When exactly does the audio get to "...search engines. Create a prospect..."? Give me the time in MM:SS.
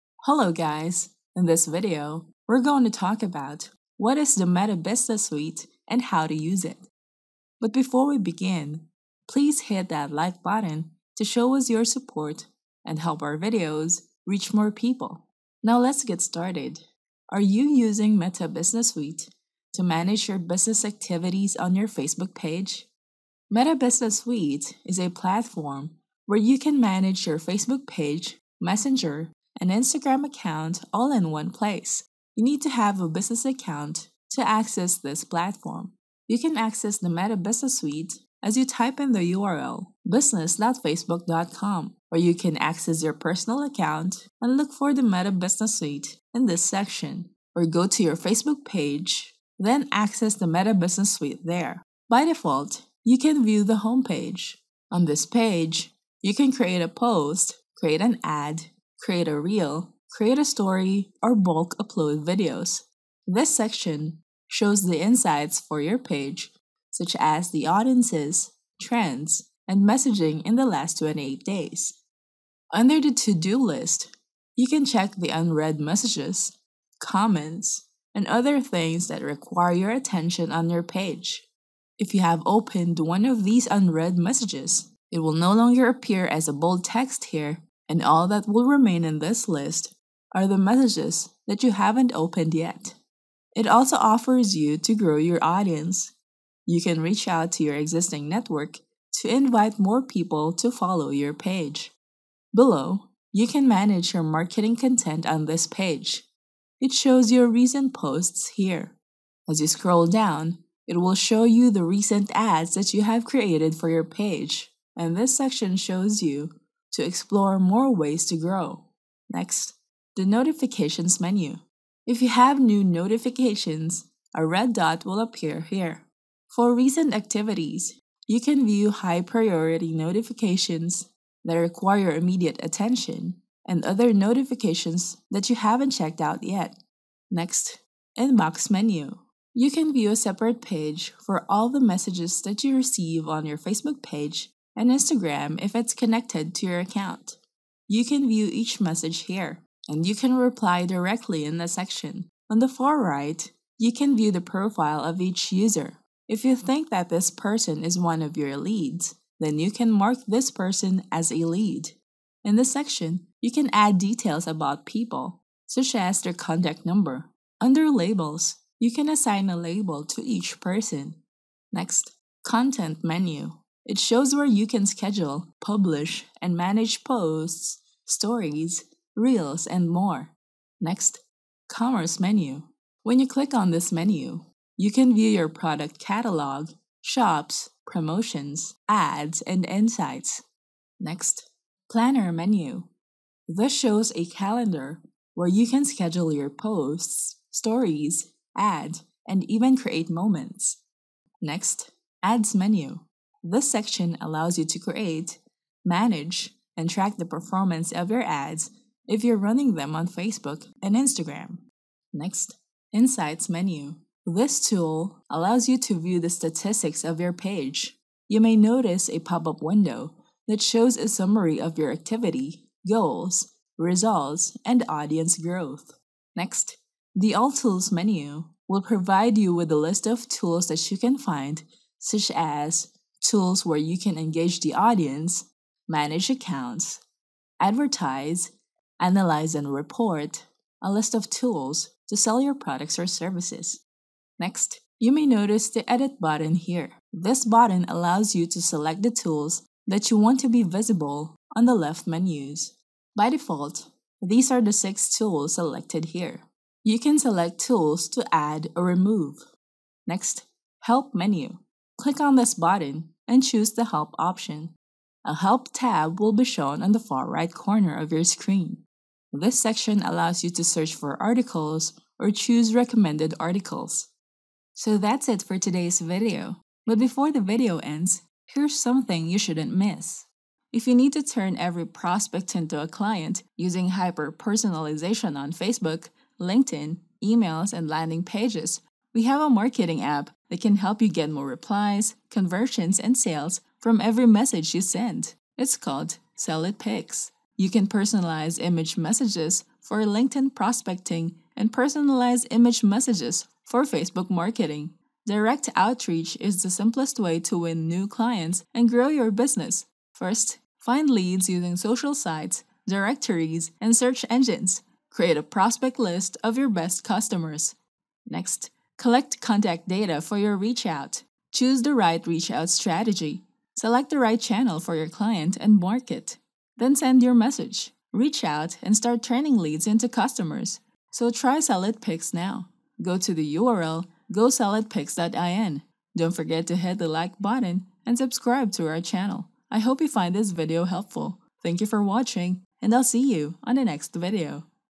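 05:13.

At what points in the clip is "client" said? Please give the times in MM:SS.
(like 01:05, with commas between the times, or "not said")
04:42, 05:08, 05:25.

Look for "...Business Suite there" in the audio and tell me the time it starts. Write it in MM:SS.
00:50.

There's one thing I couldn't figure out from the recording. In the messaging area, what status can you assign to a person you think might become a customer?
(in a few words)
lead.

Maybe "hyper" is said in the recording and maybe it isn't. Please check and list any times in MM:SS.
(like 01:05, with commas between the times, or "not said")
04:43.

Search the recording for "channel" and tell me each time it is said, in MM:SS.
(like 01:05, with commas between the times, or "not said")
05:24, 05:39.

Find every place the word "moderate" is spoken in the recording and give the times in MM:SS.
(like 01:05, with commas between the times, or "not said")
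not said.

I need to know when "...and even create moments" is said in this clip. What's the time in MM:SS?
03:19.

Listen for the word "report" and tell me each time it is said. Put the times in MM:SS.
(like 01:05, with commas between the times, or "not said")
03:59.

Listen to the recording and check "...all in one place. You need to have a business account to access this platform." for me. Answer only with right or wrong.
right.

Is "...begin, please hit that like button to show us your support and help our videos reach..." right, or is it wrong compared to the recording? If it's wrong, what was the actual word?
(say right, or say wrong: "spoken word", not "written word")
right.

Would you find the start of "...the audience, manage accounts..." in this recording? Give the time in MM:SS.
03:54.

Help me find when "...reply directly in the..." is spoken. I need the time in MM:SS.
02:30.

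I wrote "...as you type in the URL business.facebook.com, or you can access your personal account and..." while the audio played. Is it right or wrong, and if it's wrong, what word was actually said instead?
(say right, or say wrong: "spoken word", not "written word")
right.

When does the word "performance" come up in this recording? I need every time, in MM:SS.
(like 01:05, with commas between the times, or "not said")
03:27.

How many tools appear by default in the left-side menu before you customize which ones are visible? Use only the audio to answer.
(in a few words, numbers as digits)
6.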